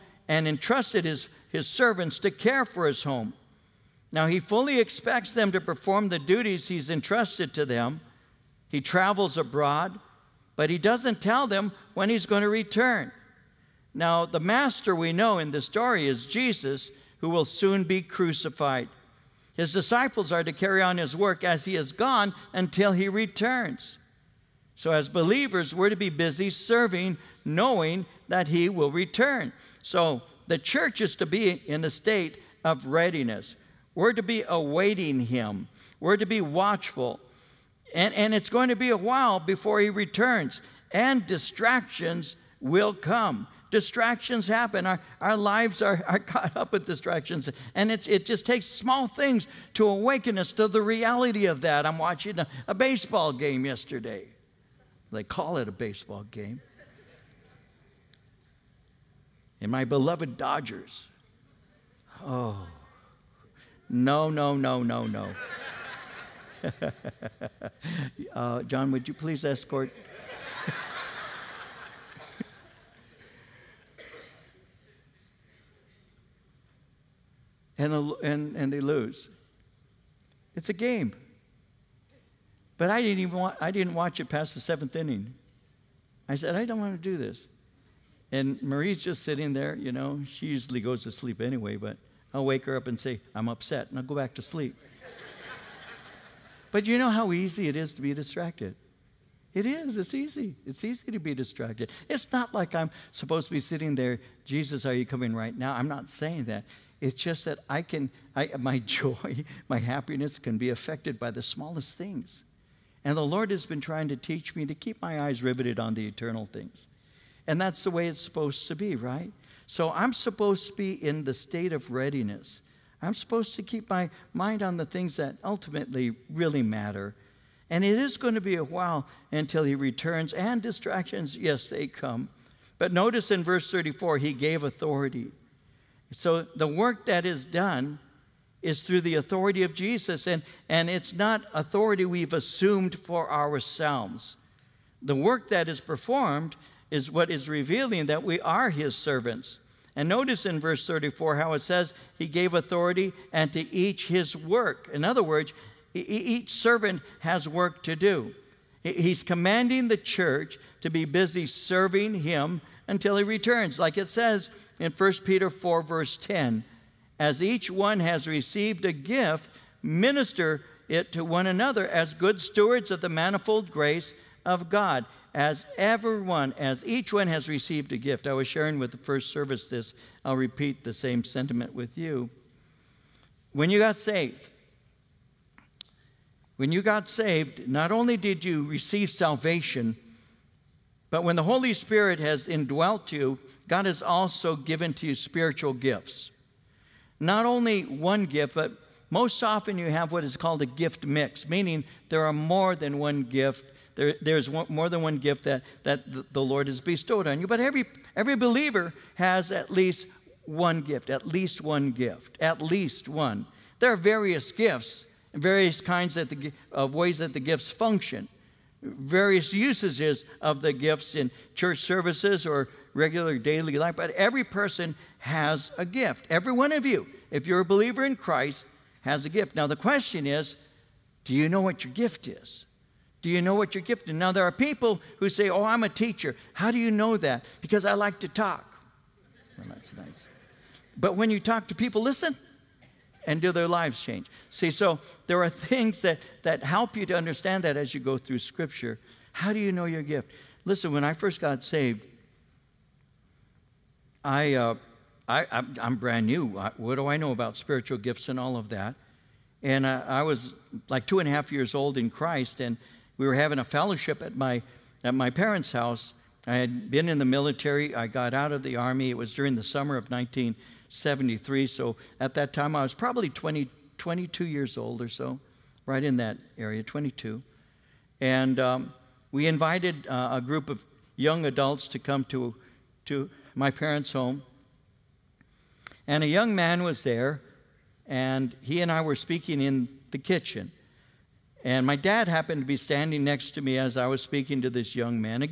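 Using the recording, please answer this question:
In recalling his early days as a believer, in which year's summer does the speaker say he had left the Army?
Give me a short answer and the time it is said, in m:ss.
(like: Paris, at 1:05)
1973, at 4:30.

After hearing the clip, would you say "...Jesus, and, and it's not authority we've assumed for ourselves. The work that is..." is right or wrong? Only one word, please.
right.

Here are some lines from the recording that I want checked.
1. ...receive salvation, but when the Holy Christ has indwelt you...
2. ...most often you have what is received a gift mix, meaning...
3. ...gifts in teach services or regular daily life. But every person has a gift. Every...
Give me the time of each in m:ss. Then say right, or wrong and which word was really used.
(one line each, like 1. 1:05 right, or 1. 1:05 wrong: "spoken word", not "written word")
1. 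3:08 wrong: "Spirit", not "Christ"
2. 3:19 wrong: "called", not "received"
3. 3:40 wrong: "church", not "teach".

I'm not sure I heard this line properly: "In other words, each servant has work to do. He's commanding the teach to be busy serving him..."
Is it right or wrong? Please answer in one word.
wrong.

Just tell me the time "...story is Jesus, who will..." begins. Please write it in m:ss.
0:15.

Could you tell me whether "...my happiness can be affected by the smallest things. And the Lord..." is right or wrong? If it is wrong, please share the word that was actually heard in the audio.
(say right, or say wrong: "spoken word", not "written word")
right.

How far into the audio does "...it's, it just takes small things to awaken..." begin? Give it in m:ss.
0:47.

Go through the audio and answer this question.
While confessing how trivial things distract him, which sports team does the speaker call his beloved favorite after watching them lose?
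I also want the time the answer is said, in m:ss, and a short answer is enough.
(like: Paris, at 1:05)
Dodgers, at 1:00.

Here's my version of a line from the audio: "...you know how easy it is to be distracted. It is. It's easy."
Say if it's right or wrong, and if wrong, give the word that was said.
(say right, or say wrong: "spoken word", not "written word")
right.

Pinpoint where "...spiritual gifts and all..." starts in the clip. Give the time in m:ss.
4:17.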